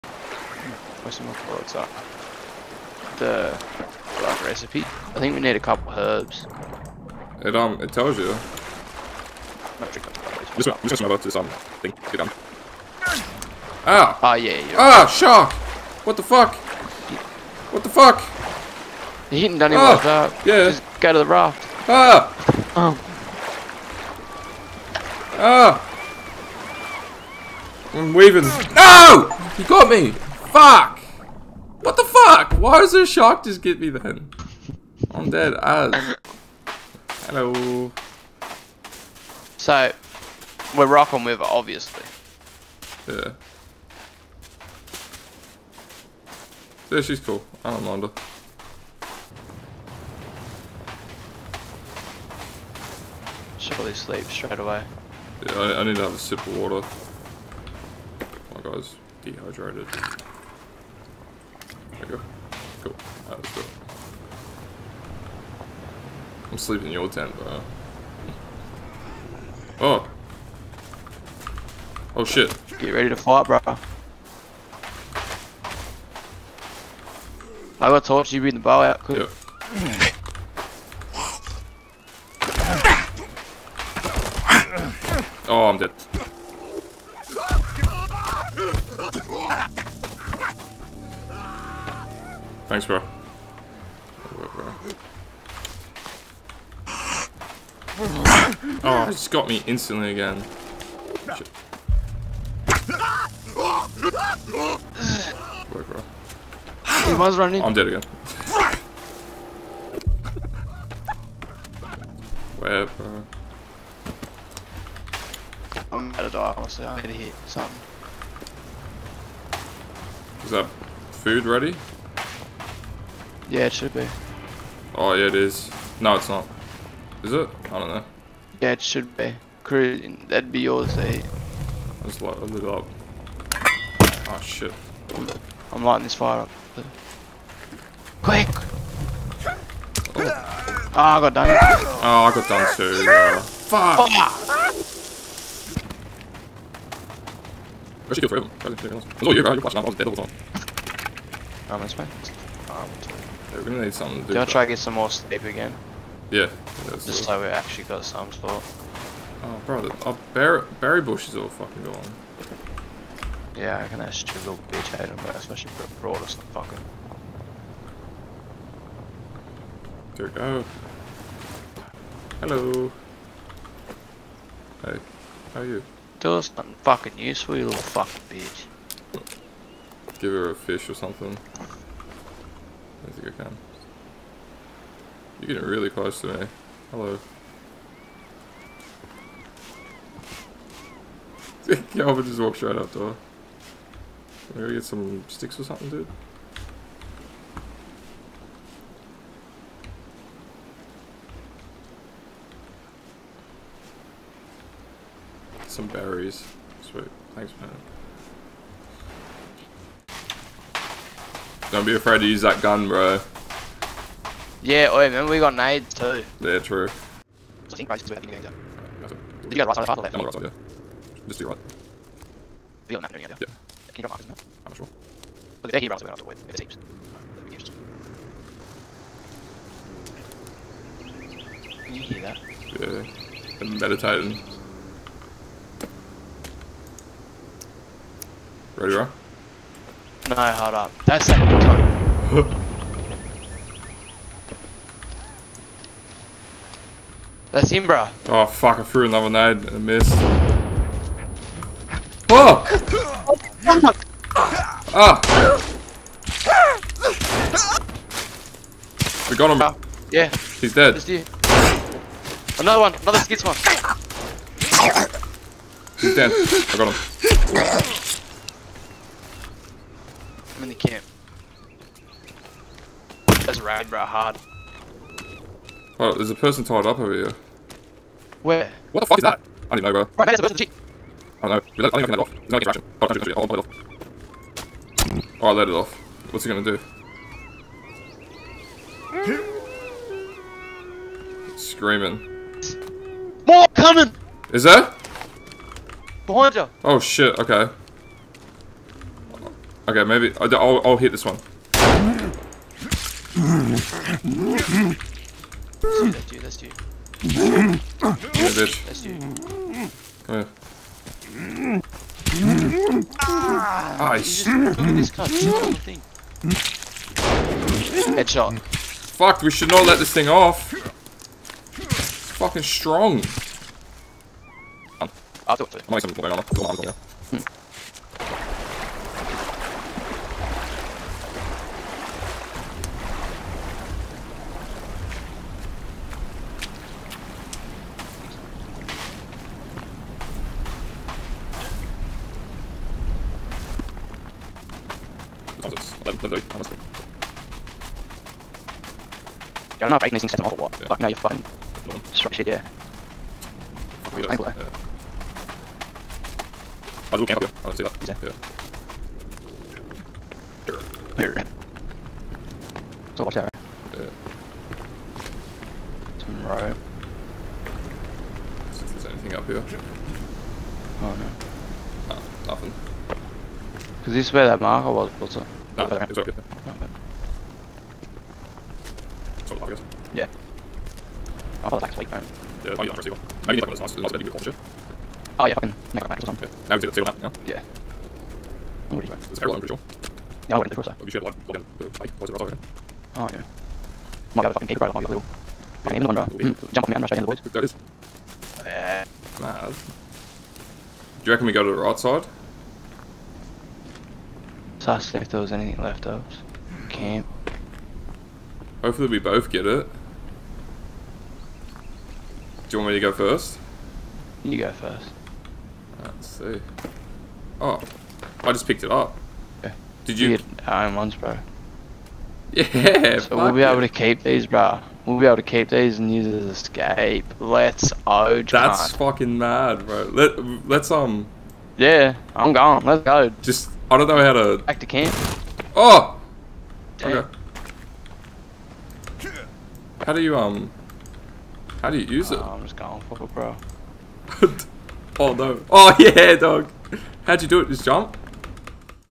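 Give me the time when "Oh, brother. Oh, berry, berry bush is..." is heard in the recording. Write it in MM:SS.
02:39.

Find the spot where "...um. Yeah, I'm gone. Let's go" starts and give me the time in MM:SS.
07:10.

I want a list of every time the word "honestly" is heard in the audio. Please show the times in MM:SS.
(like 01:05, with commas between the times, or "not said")
01:56, 05:46.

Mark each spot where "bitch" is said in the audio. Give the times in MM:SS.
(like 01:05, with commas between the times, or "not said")
02:44, 02:58, 05:08.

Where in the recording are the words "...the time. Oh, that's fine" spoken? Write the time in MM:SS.
02:30.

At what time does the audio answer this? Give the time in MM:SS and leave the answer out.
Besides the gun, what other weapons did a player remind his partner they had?
03:35.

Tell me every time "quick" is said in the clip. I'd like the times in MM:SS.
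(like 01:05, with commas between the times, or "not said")
01:18, 02:18.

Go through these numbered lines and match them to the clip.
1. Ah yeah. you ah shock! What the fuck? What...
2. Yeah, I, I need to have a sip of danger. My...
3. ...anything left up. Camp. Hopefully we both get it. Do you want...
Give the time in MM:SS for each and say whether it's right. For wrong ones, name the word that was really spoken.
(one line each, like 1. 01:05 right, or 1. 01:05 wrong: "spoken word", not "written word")
1. 00:14 right
2. 00:55 wrong: "water", not "danger"
3. 06:45 right.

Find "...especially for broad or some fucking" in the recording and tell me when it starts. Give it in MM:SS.
02:45.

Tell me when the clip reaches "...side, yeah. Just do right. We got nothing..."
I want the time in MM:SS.
03:40.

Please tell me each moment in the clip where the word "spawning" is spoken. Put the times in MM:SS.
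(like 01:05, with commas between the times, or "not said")
not said.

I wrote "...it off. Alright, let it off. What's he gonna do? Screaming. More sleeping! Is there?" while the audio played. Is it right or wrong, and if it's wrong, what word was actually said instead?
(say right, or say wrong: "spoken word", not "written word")
wrong: "coming", not "sleeping".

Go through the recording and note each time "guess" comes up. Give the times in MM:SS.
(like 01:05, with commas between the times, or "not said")
06:19.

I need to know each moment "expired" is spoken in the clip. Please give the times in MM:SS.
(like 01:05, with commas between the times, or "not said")
not said.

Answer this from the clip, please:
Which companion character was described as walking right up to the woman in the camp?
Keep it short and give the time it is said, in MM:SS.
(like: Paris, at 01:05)
Kelvin, at 03:11.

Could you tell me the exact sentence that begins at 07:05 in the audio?
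We'll be able to keep these and use it as escape.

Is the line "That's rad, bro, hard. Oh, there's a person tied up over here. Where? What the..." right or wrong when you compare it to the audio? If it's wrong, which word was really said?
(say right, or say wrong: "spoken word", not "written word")
right.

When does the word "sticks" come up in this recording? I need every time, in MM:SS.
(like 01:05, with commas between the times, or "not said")
03:15.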